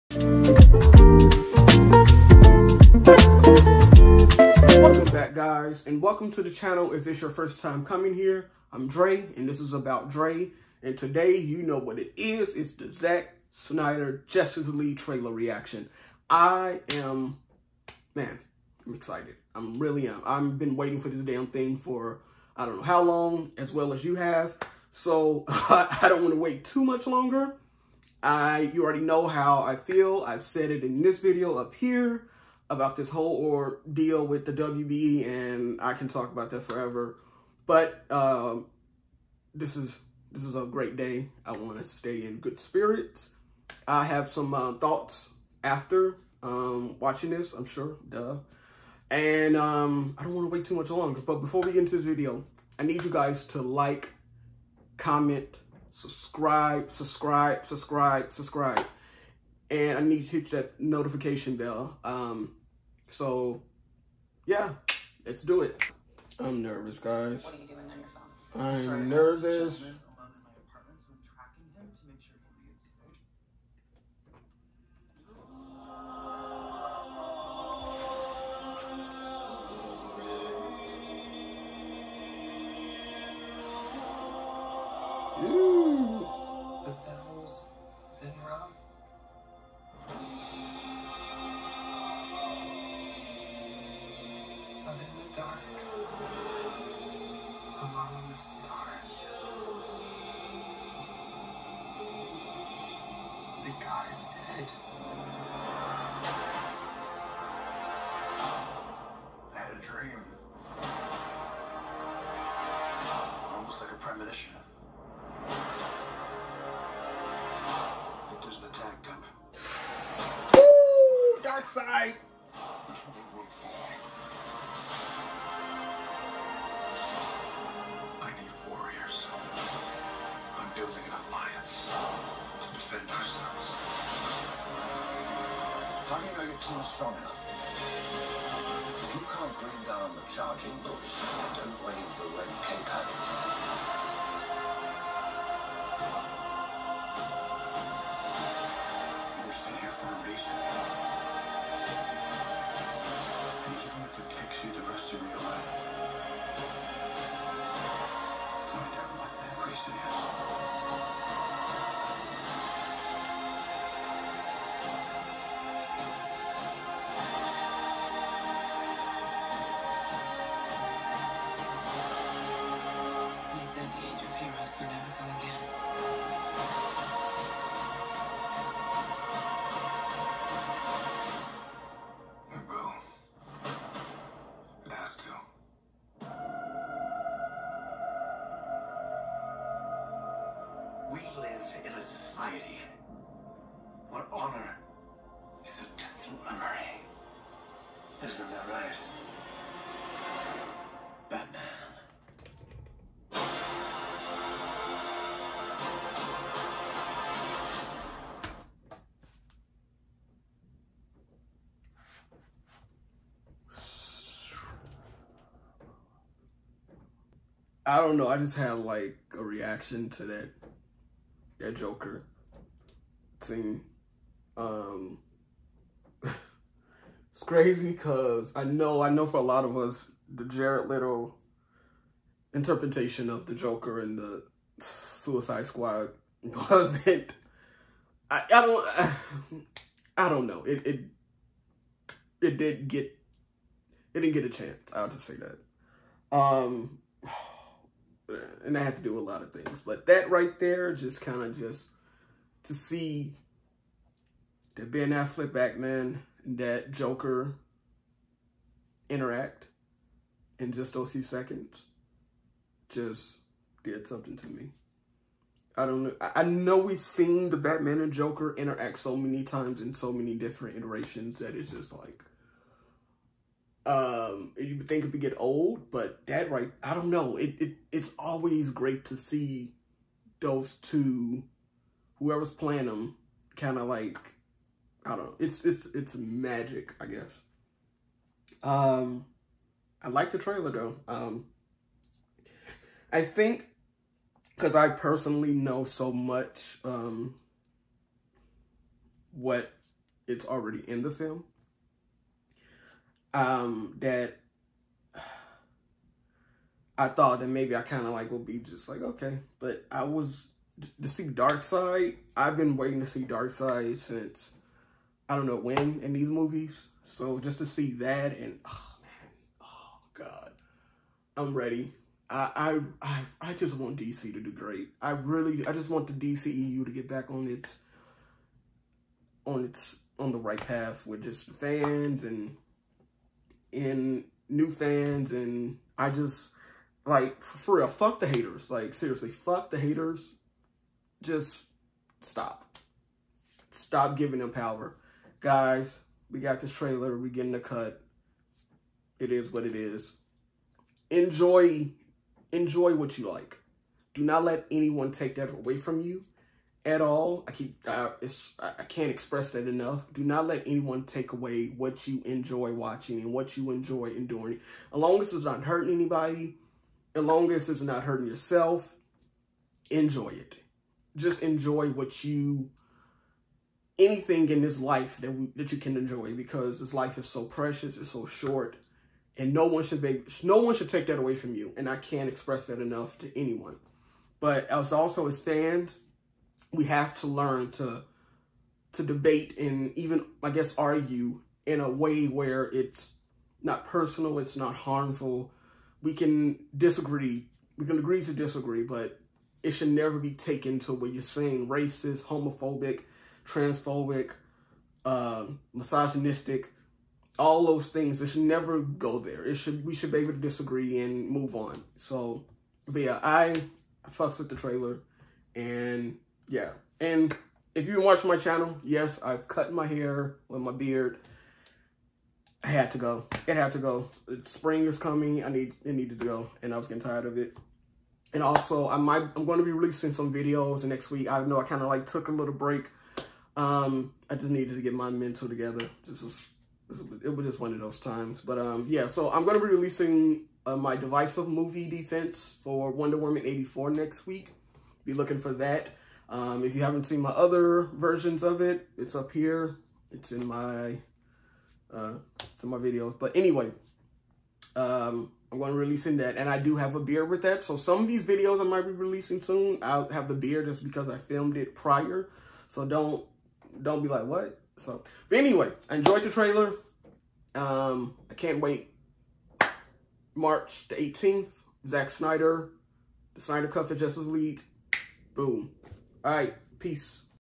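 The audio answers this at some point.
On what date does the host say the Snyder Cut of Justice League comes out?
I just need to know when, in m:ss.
7:50.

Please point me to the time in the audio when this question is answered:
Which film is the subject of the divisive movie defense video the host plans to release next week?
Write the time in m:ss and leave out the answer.
7:22.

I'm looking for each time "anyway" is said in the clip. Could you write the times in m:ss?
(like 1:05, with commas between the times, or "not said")
7:33, 7:45.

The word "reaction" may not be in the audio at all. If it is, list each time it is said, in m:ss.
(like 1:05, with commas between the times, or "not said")
0:15, 3:39.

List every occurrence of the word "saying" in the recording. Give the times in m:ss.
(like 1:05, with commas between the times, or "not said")
6:41.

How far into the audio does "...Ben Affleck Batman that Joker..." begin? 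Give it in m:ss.
4:14.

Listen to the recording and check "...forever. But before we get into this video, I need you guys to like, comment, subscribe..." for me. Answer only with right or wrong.
wrong.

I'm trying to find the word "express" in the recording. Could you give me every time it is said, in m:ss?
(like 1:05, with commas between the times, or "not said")
5:59, 6:22.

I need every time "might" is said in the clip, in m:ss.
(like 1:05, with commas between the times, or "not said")
7:08, 7:38.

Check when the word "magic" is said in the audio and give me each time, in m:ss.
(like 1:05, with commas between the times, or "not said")
4:46.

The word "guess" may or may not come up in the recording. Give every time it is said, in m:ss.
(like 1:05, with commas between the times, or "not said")
4:47, 6:30.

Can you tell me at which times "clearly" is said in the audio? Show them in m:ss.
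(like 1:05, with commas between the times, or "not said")
not said.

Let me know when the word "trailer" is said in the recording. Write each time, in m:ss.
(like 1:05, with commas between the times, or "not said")
0:14, 4:50, 5:46, 6:54, 7:46.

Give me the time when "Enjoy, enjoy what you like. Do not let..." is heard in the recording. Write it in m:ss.
5:51.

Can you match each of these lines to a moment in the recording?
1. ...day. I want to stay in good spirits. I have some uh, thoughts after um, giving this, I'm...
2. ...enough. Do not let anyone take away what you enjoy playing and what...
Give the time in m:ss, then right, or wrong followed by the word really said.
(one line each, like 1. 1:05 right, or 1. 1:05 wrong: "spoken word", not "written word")
1. 0:40 wrong: "watching", not "giving"
2. 5:59 wrong: "watching", not "playing".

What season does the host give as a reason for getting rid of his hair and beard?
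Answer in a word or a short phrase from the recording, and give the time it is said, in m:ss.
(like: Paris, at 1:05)
Spring, at 7:04.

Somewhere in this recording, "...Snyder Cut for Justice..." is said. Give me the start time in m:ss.
7:53.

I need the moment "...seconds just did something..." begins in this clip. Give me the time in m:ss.
4:21.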